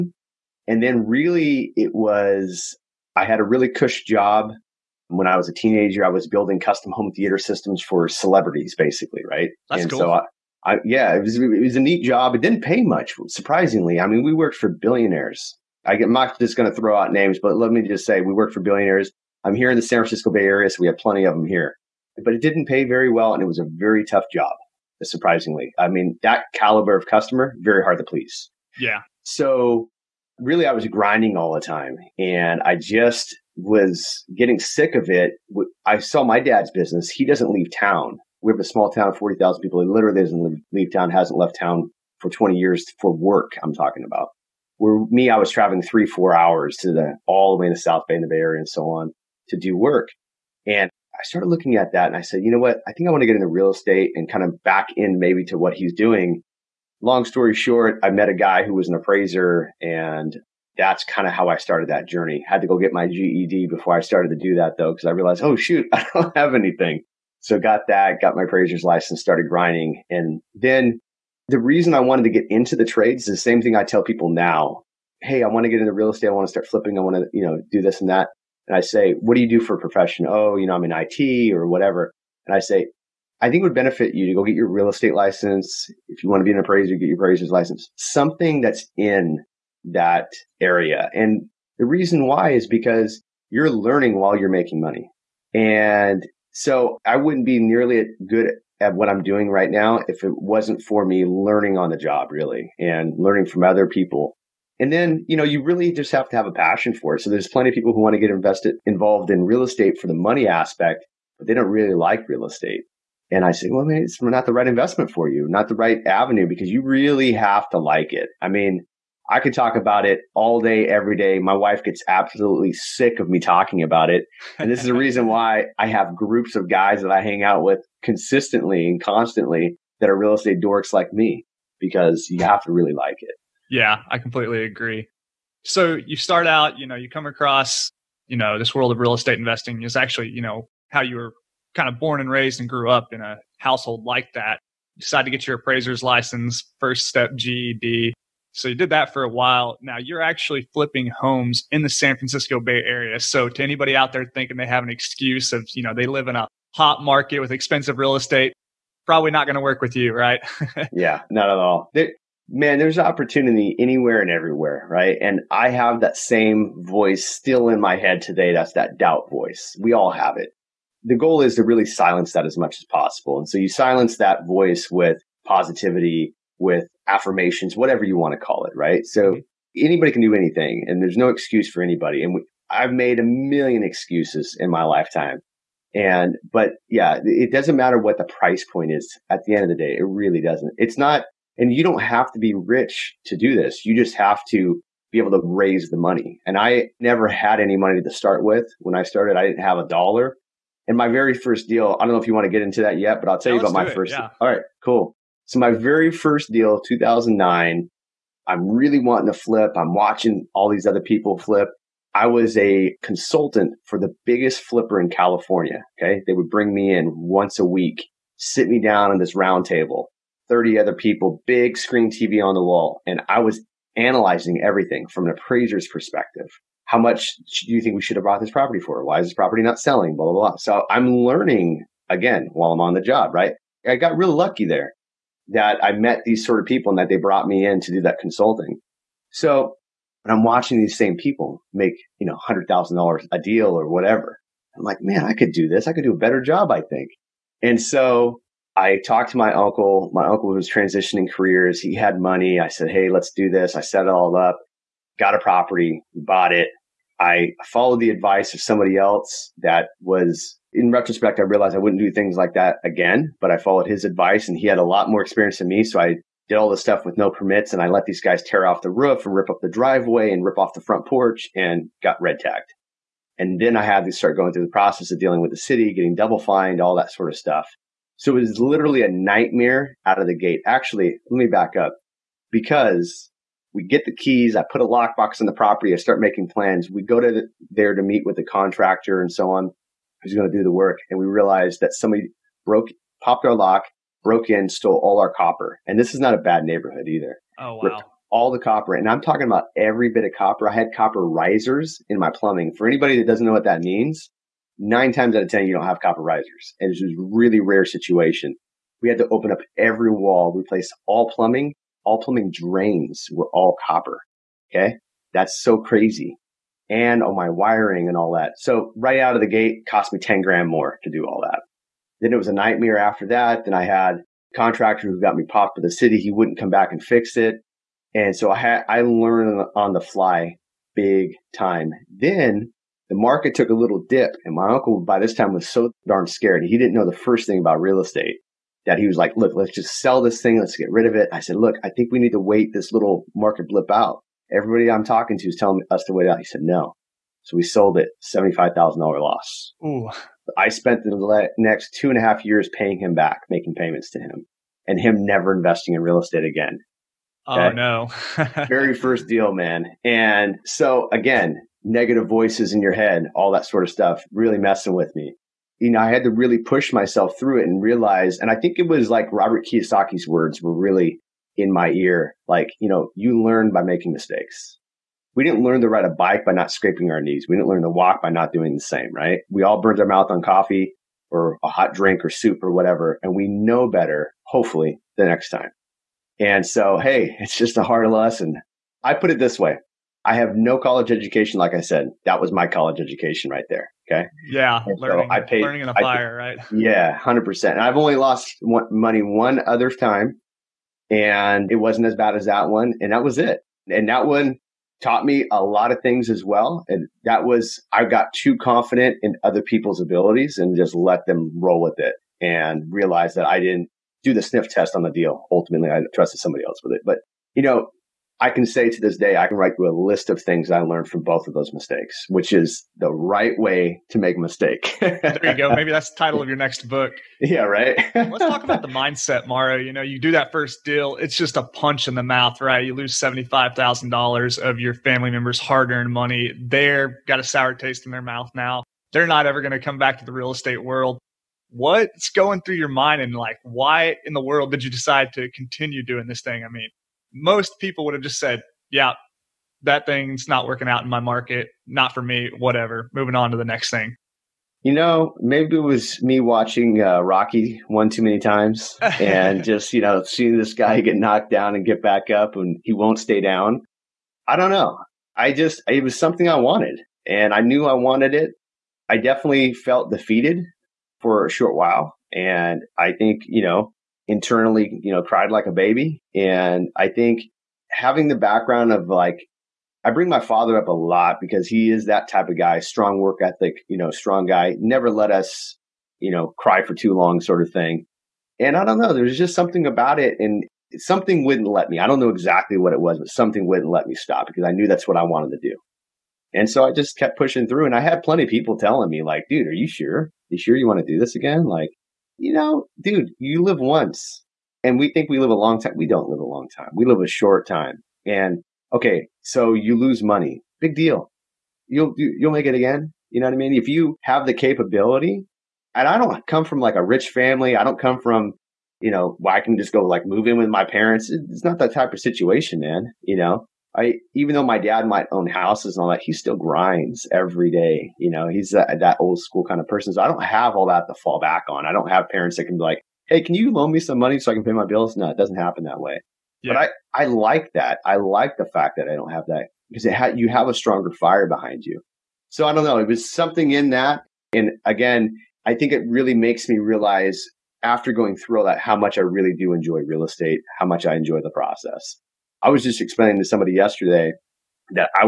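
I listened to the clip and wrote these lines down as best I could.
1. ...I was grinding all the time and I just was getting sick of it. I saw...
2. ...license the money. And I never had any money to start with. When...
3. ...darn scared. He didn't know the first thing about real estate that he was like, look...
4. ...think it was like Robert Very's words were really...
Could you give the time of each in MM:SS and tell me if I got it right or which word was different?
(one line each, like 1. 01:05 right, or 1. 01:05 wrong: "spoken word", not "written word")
1. 00:30 right
2. 03:15 wrong: "raise", not "license"
3. 05:36 right
4. 06:08 wrong: "Kiyosaki", not "Very".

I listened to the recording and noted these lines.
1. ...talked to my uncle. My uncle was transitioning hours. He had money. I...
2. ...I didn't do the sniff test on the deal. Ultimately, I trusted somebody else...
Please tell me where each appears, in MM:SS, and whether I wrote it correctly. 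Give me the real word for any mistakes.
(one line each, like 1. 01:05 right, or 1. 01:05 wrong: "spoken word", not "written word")
1. 04:09 wrong: "careers", not "hours"
2. 06:53 right.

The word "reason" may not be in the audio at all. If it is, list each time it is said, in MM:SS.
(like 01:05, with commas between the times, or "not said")
01:11, 01:31, 02:04.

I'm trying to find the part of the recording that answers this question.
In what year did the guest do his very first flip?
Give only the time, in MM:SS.
03:26.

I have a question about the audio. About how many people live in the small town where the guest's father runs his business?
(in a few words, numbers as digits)
40,000.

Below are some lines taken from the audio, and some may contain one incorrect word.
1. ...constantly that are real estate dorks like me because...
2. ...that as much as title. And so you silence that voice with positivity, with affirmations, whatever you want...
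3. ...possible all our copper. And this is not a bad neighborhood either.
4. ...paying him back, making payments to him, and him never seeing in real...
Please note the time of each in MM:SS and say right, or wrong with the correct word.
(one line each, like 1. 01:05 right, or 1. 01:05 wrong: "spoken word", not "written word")
1. 02:09 right
2. 02:52 wrong: "possible", not "title"
3. 04:54 wrong: "stole", not "possible"
4. 05:52 wrong: "investing", not "seeing".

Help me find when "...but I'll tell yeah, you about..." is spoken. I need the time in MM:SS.
03:23.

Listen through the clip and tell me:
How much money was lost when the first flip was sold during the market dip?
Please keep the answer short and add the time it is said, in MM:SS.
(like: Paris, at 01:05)
$75,000, at 05:48.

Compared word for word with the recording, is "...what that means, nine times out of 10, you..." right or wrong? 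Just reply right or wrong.
right.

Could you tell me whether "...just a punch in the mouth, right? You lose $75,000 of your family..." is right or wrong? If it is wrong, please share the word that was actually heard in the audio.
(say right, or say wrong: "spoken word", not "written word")
right.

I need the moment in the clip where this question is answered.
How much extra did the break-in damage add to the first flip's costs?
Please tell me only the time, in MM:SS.
05:20.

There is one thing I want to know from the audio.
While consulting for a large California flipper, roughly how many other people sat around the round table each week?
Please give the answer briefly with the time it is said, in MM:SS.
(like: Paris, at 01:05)
30, at 03:40.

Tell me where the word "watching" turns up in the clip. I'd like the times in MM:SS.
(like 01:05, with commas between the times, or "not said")
03:29, 04:00, 07:36.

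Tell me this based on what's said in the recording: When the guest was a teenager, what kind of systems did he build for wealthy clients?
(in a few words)
custom home theater systems.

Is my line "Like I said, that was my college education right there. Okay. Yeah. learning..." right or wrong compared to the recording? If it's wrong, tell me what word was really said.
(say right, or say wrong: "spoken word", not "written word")
right.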